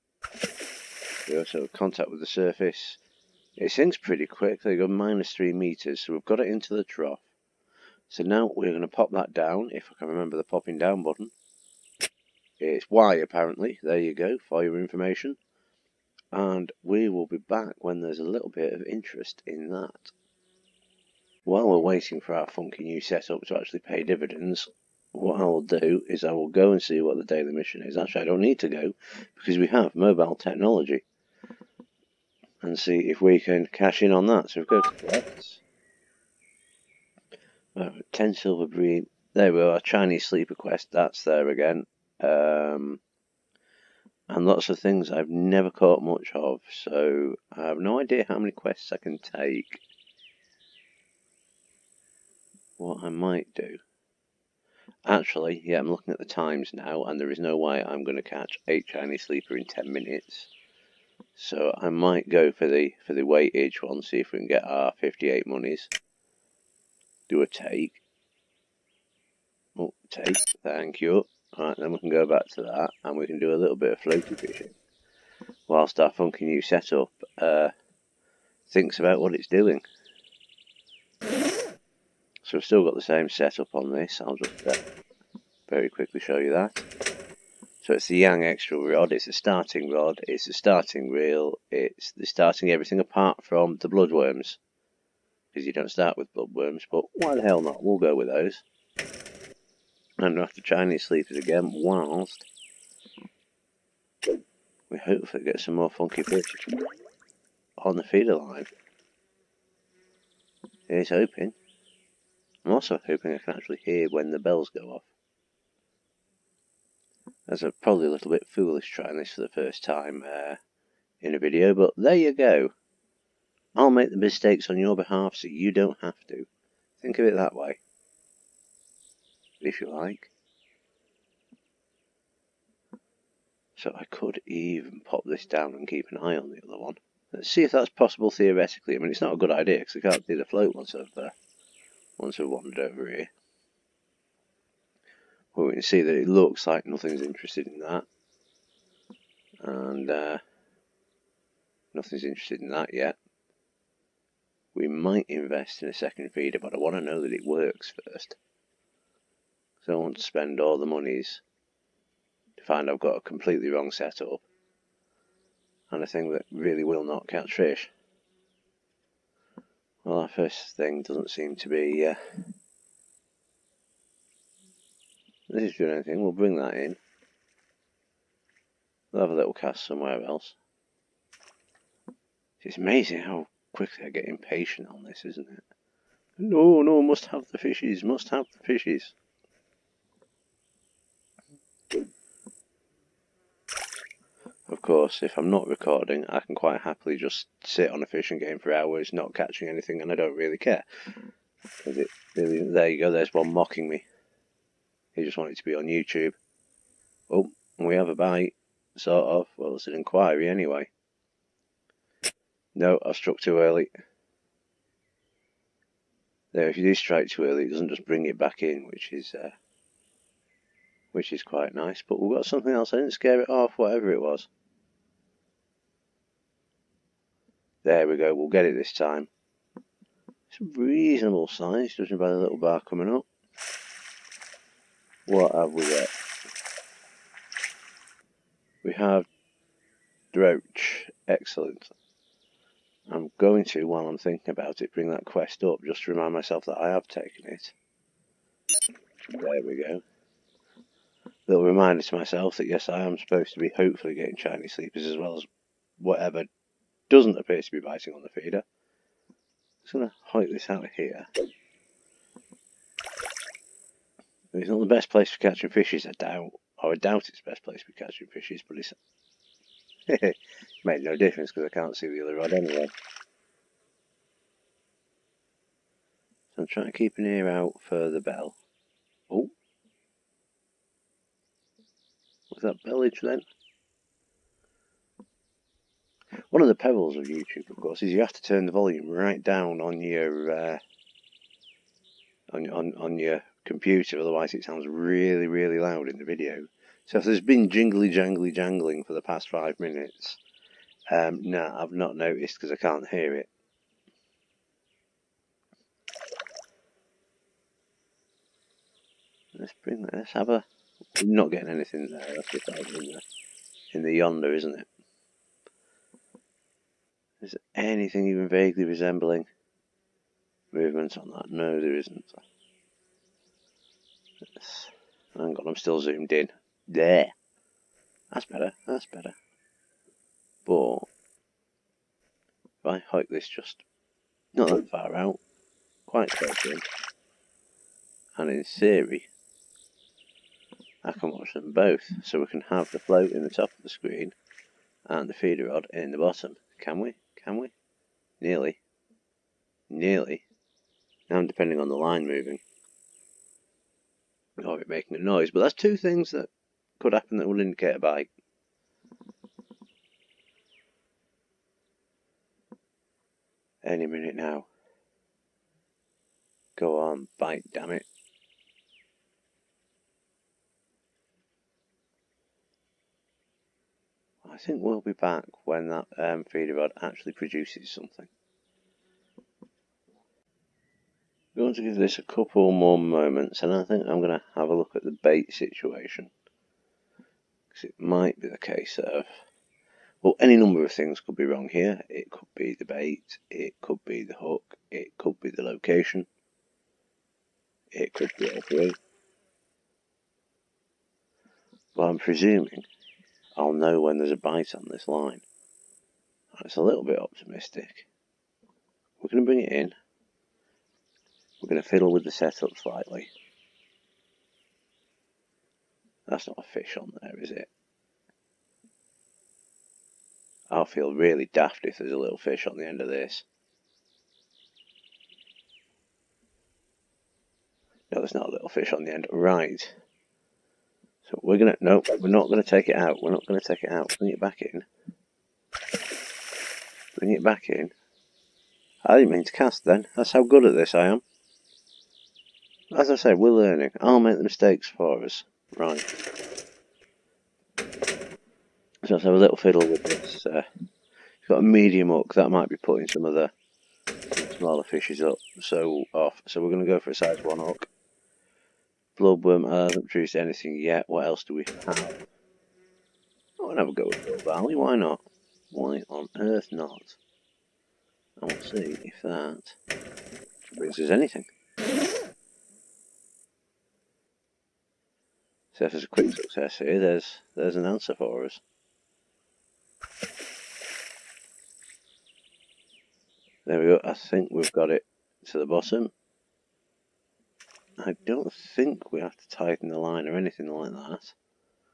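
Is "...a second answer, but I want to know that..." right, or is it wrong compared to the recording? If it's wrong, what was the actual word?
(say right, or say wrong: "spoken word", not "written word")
wrong: "feeder", not "answer".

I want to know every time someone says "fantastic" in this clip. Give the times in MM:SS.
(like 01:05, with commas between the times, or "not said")
not said.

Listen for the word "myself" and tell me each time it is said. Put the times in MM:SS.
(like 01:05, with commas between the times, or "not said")
04:06, 04:12.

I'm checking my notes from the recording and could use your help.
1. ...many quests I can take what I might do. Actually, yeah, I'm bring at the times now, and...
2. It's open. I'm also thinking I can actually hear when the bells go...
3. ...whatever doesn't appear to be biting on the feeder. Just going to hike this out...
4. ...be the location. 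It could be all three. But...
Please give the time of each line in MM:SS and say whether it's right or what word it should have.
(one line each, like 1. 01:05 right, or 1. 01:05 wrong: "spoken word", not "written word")
1. 00:48 wrong: "looking", not "bring"
2. 01:50 wrong: "hoping", not "thinking"
3. 04:15 right
4. 06:35 right.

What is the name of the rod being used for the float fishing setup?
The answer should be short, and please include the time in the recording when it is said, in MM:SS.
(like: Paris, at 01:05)
Yang extra, at 01:28.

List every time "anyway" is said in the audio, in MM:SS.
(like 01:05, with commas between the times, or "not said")
03:30, 04:32.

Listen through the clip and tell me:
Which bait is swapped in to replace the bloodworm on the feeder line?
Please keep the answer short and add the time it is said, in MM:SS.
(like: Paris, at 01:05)
barley, at 07:44.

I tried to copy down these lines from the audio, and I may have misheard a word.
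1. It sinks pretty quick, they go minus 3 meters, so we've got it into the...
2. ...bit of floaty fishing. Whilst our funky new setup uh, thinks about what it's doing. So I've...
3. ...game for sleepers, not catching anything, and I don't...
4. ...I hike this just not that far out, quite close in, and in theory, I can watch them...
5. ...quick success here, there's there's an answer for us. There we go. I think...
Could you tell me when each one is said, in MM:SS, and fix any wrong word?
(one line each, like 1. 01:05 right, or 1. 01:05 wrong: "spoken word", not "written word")
1. 00:03 right
2. 01:13 right
3. 03:18 wrong: "hours", not "sleepers"
4. 05:32 right
5. 07:56 right.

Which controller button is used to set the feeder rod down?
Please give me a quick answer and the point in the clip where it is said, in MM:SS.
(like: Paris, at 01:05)
Y, at 00:12.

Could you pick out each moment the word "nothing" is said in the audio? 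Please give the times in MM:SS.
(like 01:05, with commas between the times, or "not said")
02:26, 02:31.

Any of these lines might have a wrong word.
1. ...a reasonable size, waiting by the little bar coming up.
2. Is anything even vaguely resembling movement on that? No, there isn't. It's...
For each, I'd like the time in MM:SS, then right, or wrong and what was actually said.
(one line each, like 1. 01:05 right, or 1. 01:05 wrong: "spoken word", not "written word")
1. 03:50 wrong: "judging", not "waiting"
2. 05:17 right.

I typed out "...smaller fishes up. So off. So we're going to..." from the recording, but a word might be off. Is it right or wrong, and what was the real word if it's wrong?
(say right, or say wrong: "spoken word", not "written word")
right.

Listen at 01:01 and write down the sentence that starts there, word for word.
So I might go for the for the weightage one, see if we can get our 58 monies.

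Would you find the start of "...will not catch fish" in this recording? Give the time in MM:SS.
02:46.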